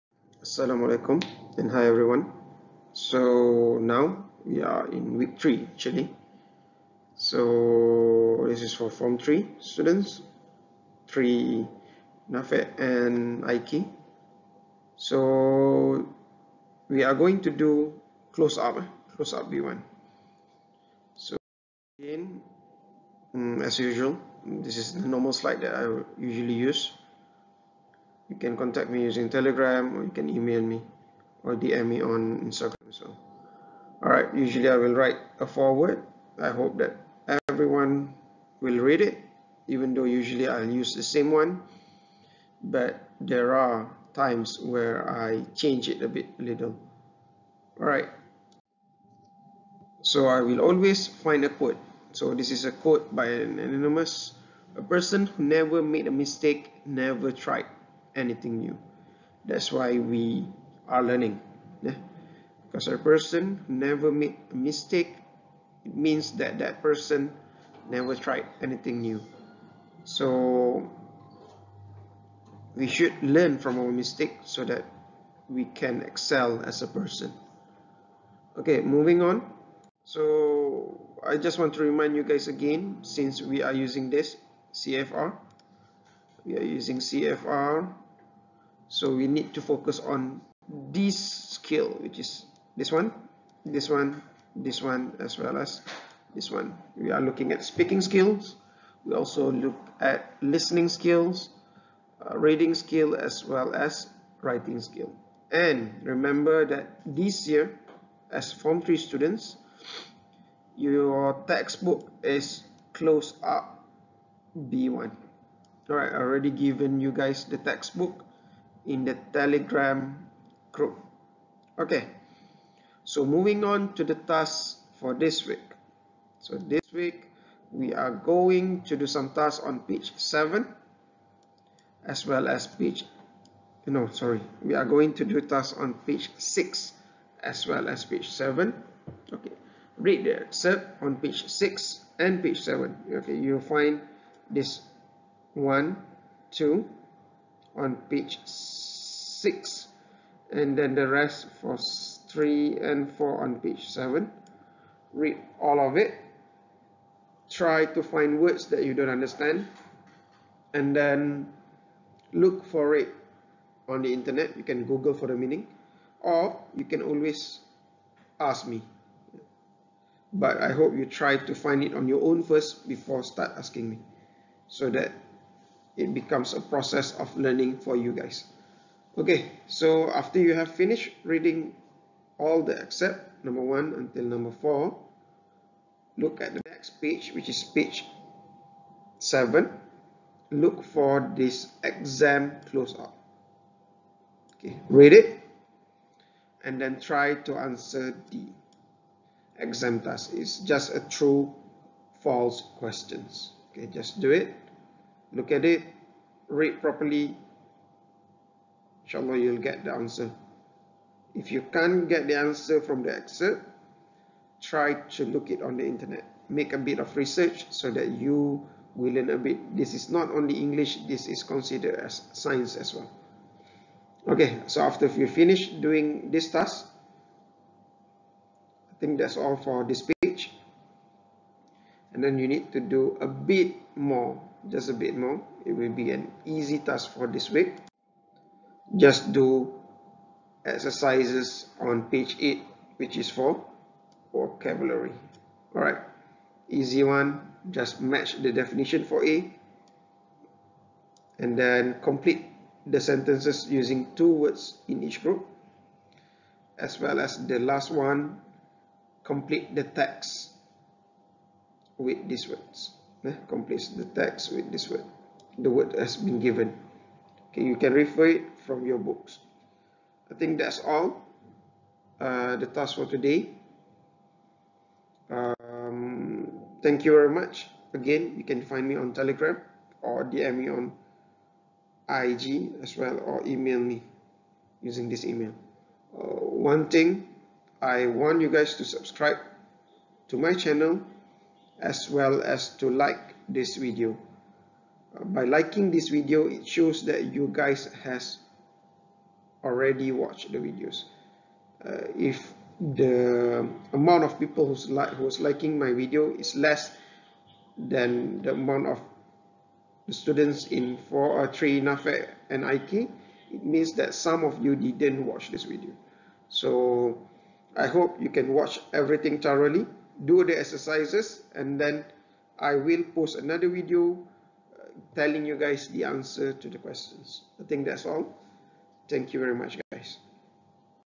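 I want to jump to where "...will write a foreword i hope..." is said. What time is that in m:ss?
0:34.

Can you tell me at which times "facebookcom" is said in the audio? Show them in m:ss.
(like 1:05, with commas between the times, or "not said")
not said.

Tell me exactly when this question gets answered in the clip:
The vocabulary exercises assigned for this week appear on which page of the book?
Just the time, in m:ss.
4:02.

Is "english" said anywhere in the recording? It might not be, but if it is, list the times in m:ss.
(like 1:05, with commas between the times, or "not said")
3:40.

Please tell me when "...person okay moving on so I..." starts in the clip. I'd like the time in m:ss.
1:16.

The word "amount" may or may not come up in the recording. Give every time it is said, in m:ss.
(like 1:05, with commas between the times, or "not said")
5:03, 5:08.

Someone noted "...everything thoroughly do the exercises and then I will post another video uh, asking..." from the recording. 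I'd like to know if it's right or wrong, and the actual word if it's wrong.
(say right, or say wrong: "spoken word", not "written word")
wrong: "telling", not "asking".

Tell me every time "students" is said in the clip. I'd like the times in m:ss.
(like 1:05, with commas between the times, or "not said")
0:09, 1:48, 5:10.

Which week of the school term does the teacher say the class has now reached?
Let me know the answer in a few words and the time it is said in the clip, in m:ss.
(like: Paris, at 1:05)
Week 3, at 0:05.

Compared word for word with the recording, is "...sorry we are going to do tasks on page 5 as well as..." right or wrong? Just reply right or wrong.
wrong.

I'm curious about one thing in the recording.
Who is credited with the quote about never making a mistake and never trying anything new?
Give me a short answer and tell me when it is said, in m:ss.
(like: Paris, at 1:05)
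Anonymous, at 0:53.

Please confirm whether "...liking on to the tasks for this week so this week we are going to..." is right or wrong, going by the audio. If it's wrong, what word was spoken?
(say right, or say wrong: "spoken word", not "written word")
wrong: "moving", not "liking".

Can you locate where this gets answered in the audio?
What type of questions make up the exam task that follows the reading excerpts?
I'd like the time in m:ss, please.
3:21.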